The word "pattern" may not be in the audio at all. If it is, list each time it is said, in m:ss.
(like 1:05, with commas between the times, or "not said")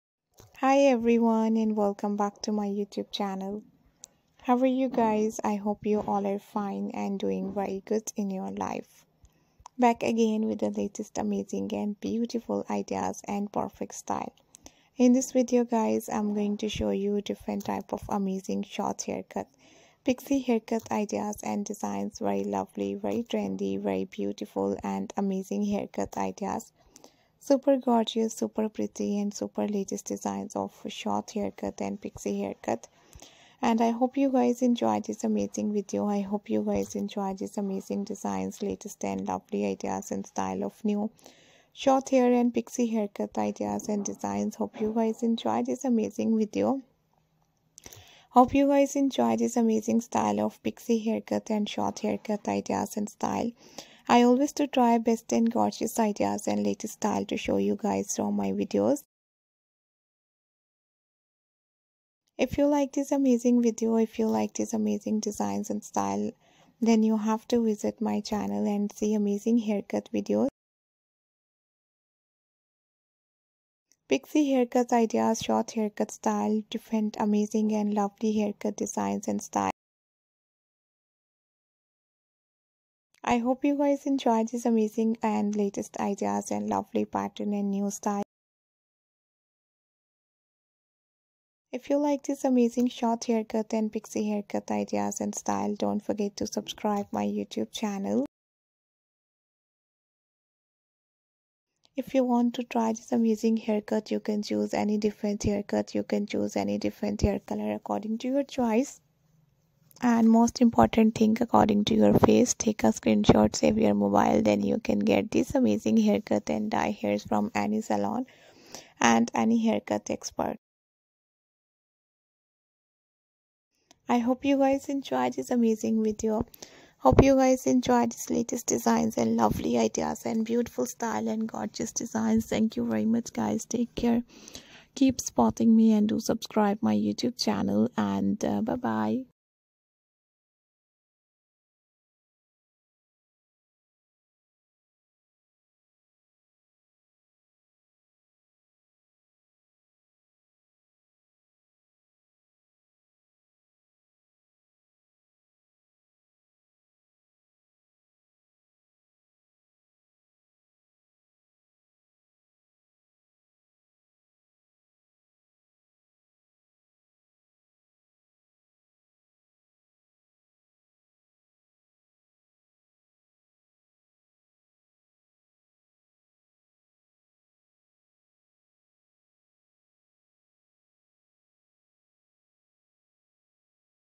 1:27.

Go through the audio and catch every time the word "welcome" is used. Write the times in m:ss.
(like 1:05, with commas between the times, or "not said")
0:01.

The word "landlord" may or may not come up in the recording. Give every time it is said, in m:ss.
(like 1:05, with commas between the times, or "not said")
not said.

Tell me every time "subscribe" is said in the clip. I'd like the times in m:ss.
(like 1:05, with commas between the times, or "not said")
1:36, 2:16.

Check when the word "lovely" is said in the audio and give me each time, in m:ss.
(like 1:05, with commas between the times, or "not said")
0:22, 0:39, 1:17, 1:26, 2:09.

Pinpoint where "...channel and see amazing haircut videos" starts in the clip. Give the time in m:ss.
1:08.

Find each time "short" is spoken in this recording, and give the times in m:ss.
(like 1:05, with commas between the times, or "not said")
0:18, 0:30, 0:41, 0:51, 1:15, 1:32.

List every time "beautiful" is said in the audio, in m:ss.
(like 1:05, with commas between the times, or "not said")
0:11, 0:24, 2:10.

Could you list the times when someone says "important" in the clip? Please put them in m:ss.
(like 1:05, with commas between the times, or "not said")
1:50.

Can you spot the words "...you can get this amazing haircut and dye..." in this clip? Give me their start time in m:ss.
1:54.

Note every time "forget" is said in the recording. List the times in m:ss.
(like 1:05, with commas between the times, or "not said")
1:36.